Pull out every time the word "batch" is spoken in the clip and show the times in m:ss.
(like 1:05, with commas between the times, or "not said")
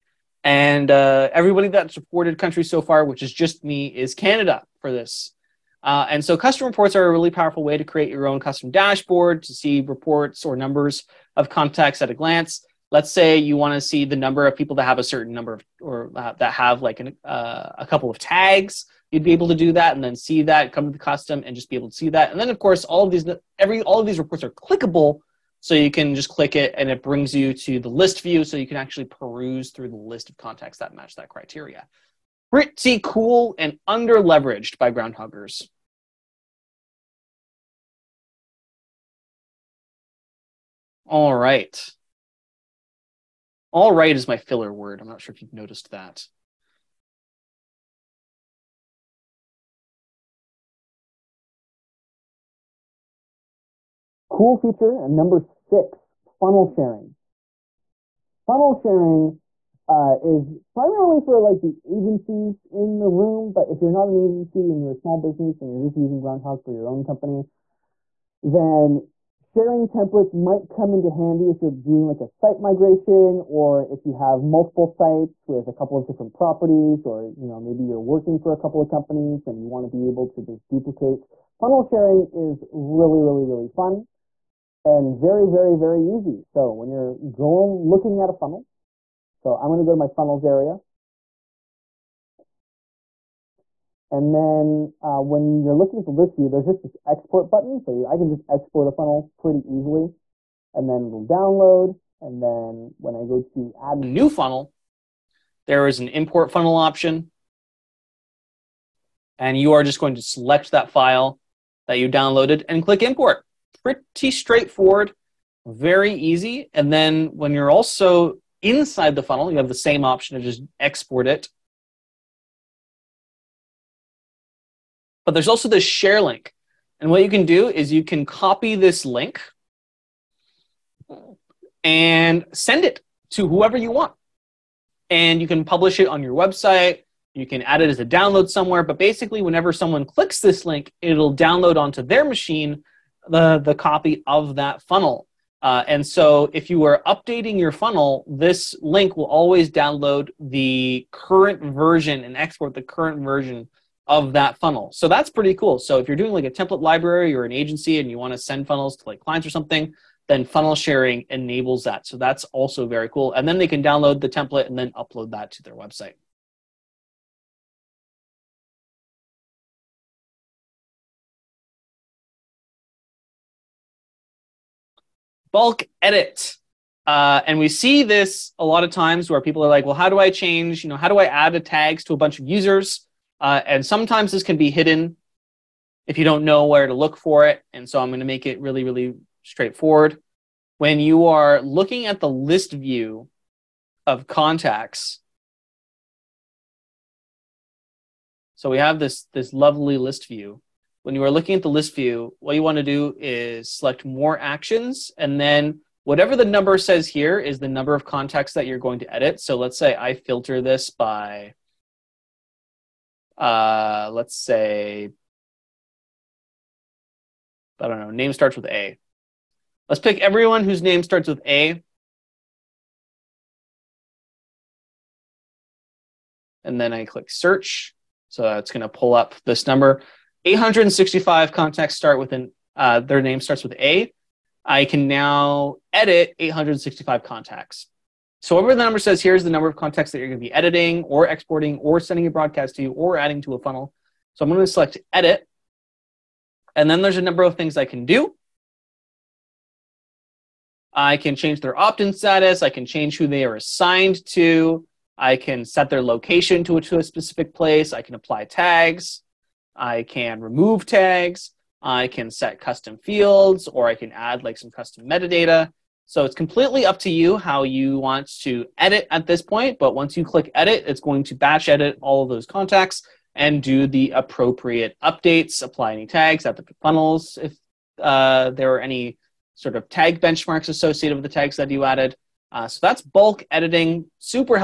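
4:31.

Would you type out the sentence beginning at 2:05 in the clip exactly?
But there's also this share link.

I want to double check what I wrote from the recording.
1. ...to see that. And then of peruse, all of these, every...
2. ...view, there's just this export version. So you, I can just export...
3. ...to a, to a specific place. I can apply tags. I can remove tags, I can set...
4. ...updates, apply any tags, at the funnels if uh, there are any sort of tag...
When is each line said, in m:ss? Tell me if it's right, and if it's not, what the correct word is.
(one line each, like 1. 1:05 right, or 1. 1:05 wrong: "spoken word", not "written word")
1. 0:21 wrong: "course", not "peruse"
2. 1:36 wrong: "button", not "version"
3. 4:16 right
4. 4:35 right.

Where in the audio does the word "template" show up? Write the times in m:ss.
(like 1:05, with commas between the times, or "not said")
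1:09, 2:36, 2:44.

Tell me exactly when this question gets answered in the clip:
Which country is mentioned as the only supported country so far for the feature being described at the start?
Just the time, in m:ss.
0:04.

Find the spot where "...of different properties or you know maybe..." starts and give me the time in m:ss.
1:15.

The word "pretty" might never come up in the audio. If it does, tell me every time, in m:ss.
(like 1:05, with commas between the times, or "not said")
0:32, 1:39, 1:53, 2:35.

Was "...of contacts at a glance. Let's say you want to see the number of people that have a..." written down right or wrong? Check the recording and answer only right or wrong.
right.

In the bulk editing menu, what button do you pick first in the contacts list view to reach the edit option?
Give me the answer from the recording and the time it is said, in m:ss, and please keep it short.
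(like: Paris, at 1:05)
More actions, at 3:24.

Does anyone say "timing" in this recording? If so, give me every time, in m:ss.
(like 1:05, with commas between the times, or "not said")
not said.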